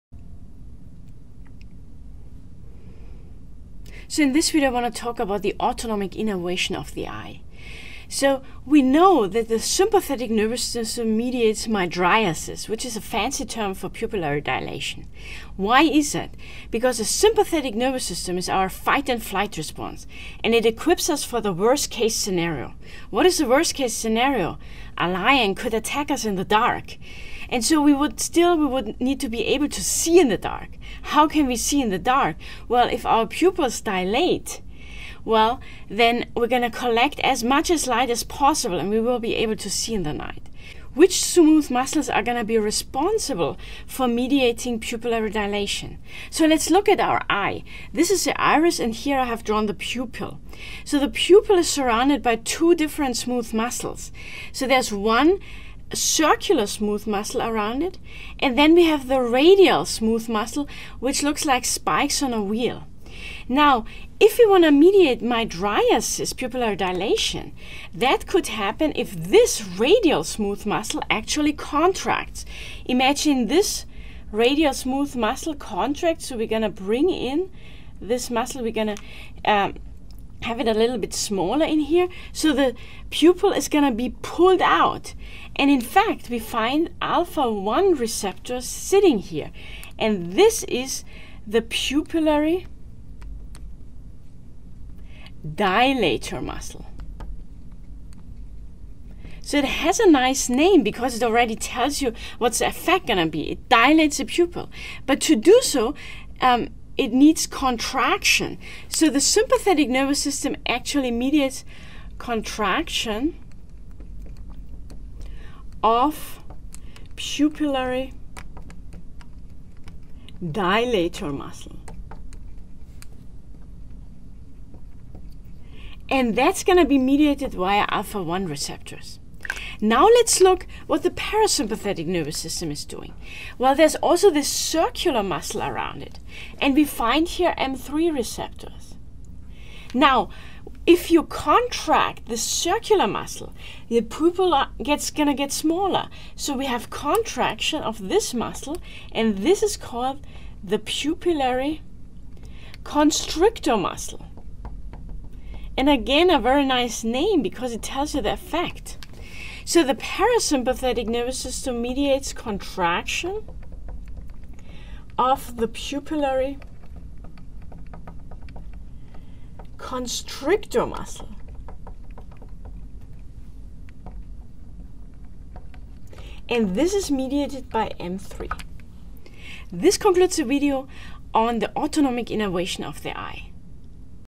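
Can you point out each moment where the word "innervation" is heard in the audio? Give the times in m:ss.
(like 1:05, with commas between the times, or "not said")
0:06, 3:02.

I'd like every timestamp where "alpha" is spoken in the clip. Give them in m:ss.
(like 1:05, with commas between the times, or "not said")
1:27, 2:07.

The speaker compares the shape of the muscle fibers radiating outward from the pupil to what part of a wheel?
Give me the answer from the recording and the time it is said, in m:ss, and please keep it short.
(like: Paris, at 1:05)
Spikes, at 1:01.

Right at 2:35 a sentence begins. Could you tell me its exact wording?
And again, a very nice name because it tells you the effect.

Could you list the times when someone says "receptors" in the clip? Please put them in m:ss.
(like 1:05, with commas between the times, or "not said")
1:27, 2:08, 2:18.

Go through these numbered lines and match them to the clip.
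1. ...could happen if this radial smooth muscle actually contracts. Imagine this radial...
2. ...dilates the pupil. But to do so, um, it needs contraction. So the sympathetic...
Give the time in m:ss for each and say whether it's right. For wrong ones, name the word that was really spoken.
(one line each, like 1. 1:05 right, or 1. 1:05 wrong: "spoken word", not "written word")
1. 1:08 right
2. 1:43 right.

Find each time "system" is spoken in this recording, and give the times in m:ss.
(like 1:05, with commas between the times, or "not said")
0:10, 0:18, 1:50, 2:12, 2:41.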